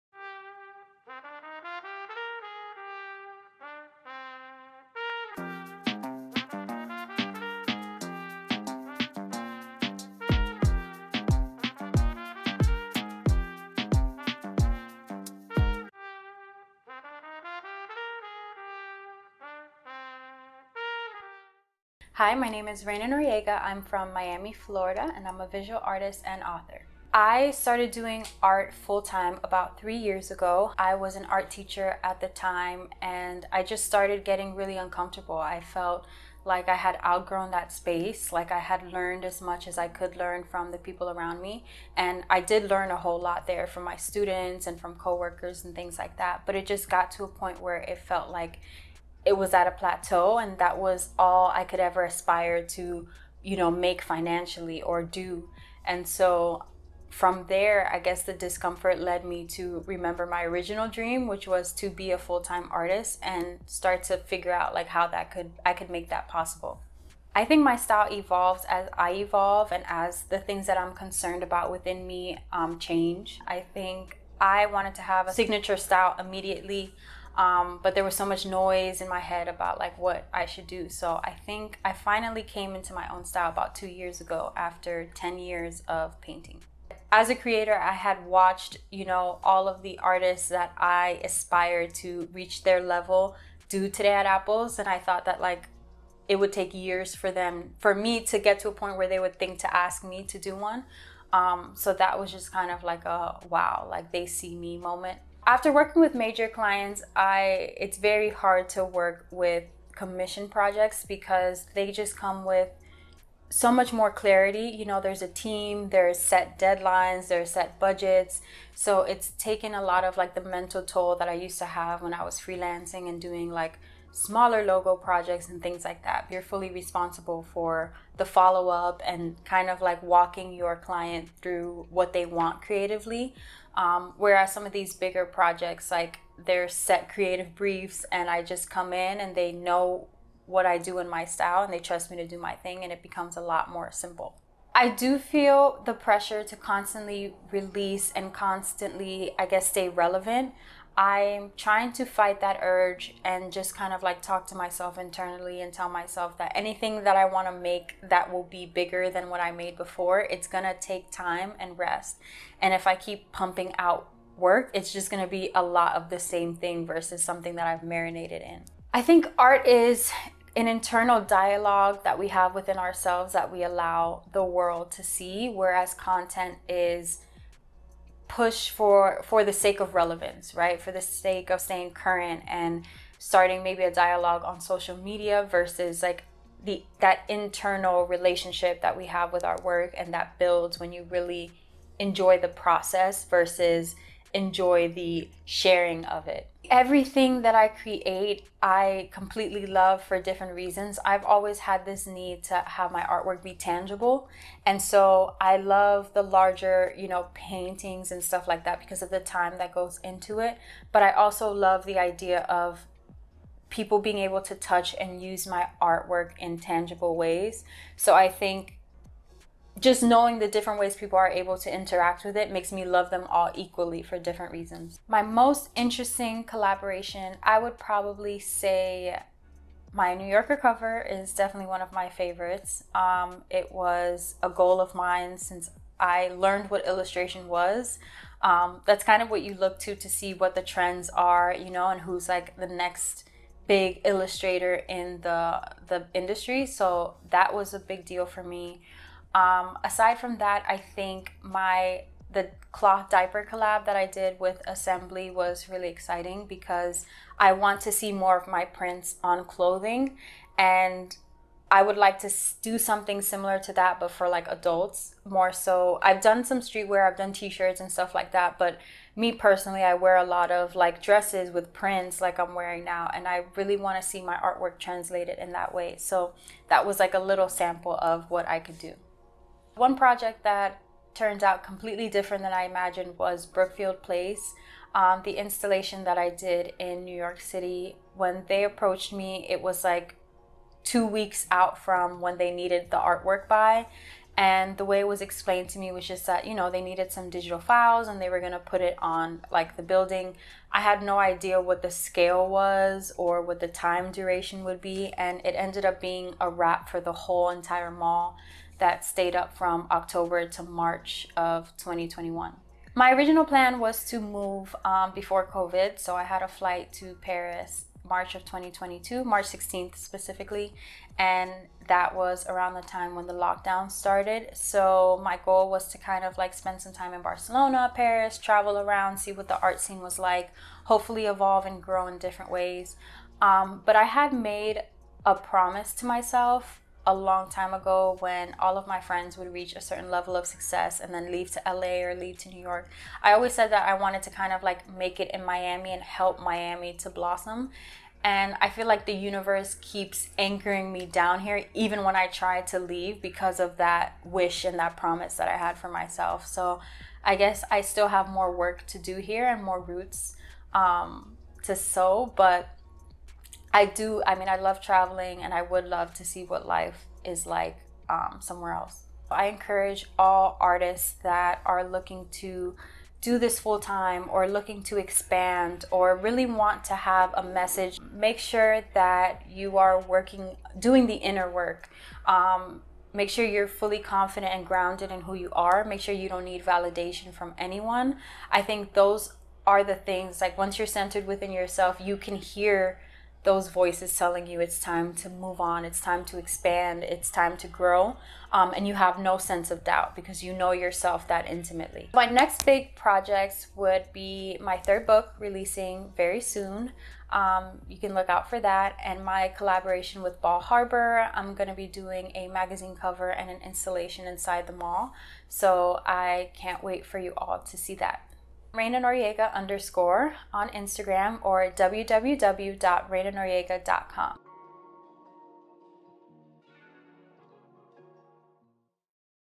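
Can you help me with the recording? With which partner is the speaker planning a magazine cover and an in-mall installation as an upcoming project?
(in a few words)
Bal Harbour.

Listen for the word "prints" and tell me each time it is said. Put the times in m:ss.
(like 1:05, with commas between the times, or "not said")
4:18, 4:31.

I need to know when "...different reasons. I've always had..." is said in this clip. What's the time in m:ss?
3:20.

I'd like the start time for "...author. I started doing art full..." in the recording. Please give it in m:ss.
0:26.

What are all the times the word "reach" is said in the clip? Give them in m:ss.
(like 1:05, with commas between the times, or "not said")
1:32, 5:39.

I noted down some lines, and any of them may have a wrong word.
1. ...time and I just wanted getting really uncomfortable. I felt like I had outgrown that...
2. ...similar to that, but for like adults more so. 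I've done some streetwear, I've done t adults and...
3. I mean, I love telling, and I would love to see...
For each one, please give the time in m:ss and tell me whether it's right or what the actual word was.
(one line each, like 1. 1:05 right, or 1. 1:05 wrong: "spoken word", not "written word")
1. 0:32 wrong: "started", not "wanted"
2. 4:23 wrong: "shirts", not "adults"
3. 6:04 wrong: "traveling", not "telling".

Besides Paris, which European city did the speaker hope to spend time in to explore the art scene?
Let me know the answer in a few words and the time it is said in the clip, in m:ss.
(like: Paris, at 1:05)
Barcelona, at 5:27.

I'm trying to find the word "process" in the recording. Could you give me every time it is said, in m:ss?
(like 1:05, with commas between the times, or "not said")
3:12.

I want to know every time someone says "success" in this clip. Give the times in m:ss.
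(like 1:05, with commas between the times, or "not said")
5:40.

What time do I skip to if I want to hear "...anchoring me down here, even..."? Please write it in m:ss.
5:50.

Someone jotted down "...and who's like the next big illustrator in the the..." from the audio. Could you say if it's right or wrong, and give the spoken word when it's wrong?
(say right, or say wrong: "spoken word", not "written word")
right.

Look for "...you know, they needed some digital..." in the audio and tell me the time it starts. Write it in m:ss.
4:56.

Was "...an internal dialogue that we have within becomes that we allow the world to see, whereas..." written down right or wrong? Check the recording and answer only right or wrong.
wrong.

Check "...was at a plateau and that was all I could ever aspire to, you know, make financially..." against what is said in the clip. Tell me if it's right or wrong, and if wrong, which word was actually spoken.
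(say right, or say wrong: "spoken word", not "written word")
right.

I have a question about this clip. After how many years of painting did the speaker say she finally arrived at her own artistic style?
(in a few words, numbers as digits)
10 years.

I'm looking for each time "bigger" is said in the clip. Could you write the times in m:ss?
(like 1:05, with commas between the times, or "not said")
2:14, 2:38.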